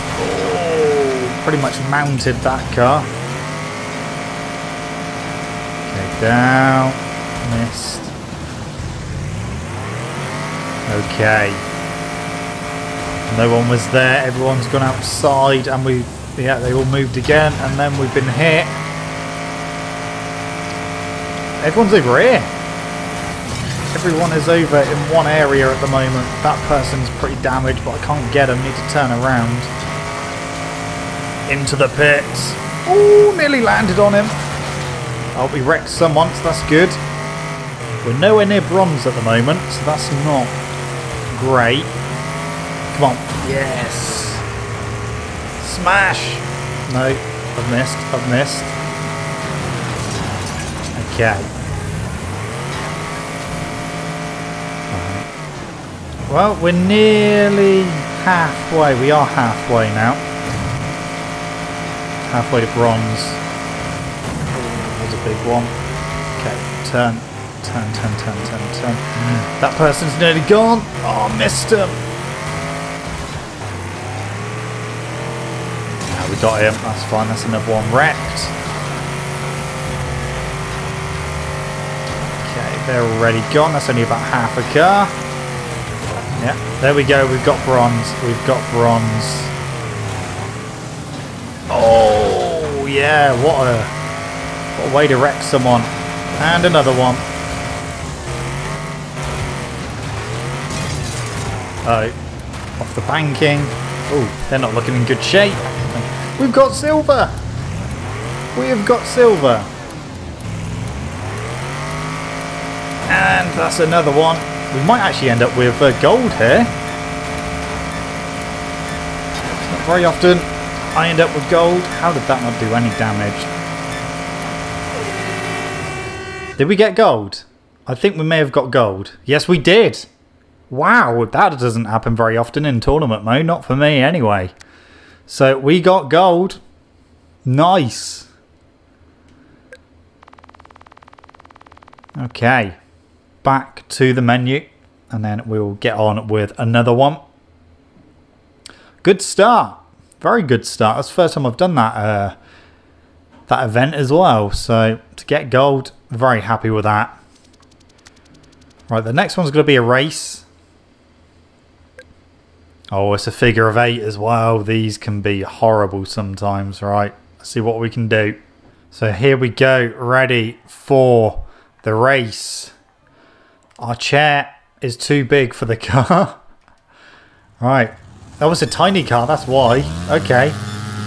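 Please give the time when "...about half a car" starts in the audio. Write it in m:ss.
1:24.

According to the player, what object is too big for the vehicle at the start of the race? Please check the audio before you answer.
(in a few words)
Our chair.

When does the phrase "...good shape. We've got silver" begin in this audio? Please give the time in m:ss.
1:45.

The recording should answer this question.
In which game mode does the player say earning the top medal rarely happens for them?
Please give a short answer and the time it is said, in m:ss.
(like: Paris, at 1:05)
tournament mode, at 2:12.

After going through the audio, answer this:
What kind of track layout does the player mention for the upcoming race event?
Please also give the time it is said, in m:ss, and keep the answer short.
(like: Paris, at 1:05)
figure of eight, at 2:43.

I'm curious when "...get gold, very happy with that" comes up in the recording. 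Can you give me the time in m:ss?
2:35.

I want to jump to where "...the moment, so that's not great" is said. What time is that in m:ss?
0:39.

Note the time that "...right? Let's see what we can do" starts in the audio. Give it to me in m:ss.
2:46.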